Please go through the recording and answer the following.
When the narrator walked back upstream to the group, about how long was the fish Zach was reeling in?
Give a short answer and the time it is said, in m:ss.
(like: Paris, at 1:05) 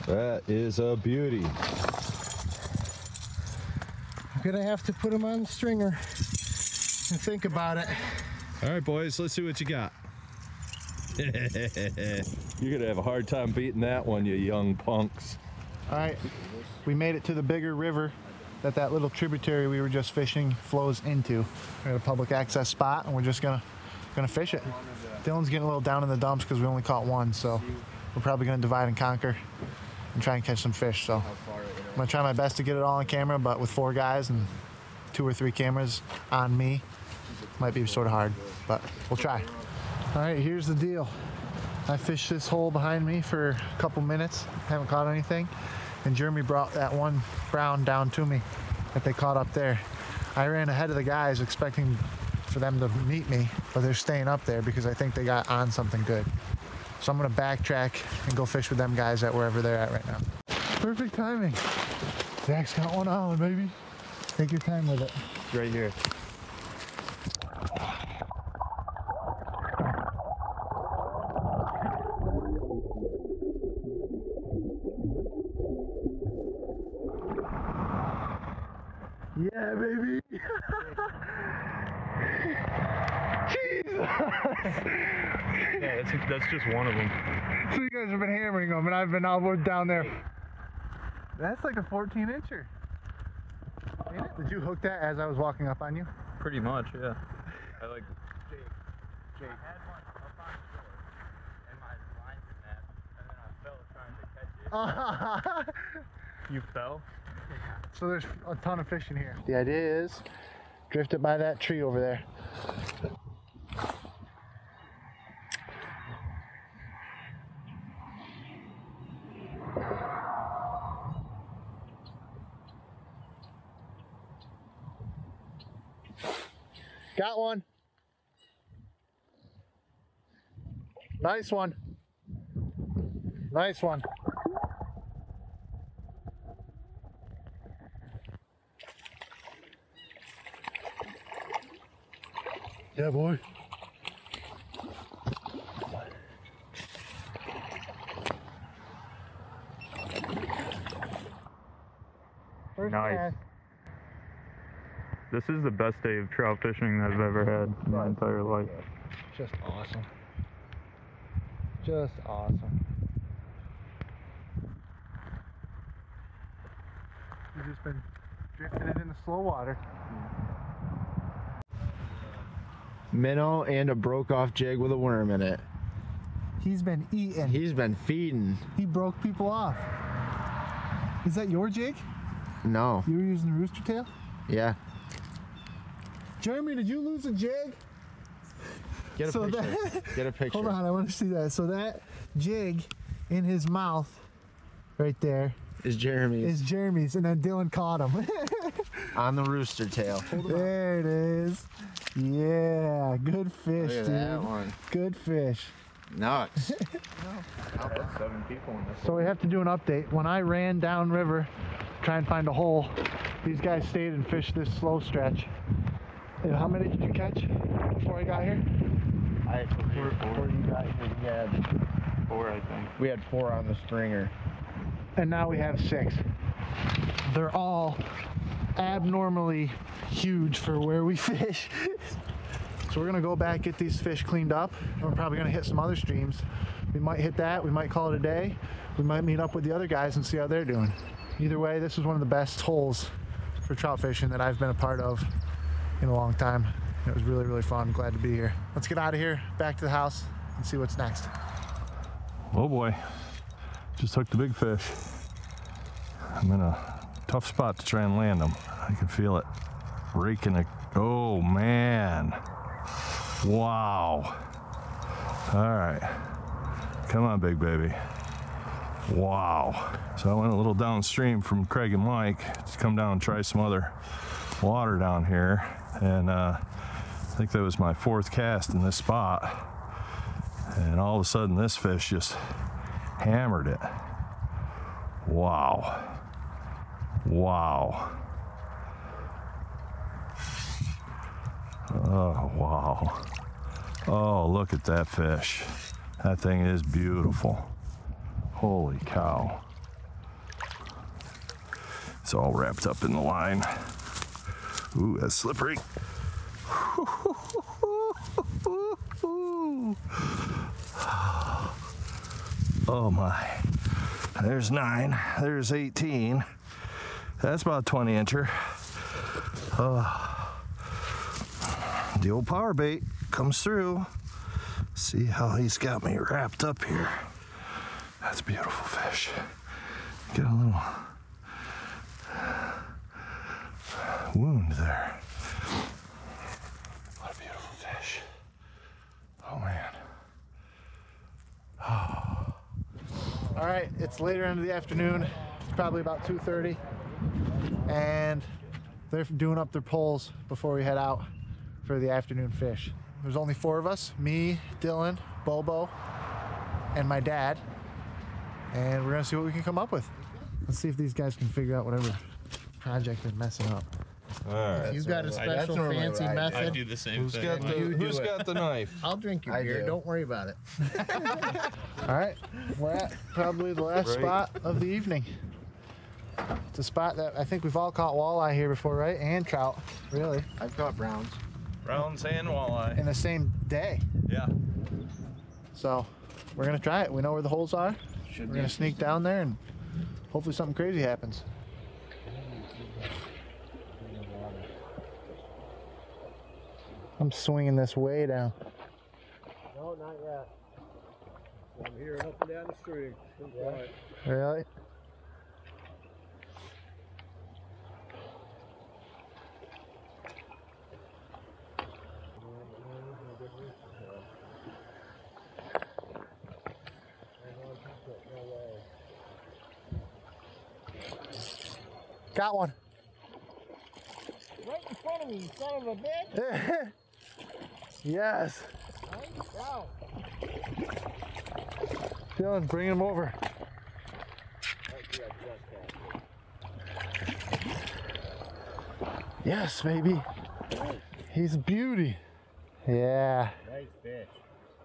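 14 inches, at 1:31.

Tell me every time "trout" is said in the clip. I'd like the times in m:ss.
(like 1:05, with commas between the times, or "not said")
2:36, 4:03, 6:19.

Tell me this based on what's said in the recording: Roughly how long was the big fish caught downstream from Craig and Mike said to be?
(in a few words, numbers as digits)
20 inches.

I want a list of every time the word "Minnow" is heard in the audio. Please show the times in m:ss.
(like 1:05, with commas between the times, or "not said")
2:53.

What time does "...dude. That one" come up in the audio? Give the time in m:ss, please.
3:23.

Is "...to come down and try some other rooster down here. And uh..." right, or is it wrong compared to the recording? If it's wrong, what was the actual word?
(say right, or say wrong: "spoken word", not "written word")
wrong: "water", not "rooster".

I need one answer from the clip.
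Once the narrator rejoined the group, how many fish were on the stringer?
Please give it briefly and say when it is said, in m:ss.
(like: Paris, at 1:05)
6, at 3:45.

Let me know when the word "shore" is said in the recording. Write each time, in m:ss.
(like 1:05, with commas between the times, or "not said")
1:40.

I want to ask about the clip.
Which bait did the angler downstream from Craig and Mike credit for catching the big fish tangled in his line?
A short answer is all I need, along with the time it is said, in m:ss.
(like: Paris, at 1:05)
power bait, at 5:22.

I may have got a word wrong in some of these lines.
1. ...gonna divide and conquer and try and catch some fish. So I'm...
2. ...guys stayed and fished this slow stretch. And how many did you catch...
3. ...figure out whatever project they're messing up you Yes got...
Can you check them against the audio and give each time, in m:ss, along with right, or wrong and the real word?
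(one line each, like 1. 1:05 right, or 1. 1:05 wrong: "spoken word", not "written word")
1. 0:28 right
2. 3:33 right
3. 6:01 wrong: "You", not "Yes".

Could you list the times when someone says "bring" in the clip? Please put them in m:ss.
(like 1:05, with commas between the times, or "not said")
7:12.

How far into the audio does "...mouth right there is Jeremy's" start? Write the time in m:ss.
3:13.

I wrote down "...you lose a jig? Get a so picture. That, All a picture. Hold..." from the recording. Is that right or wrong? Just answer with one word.
wrong.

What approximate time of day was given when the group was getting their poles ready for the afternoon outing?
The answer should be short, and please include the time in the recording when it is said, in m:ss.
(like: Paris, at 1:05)
2:30, at 5:46.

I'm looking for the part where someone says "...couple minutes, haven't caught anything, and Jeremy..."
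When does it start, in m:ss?
0:43.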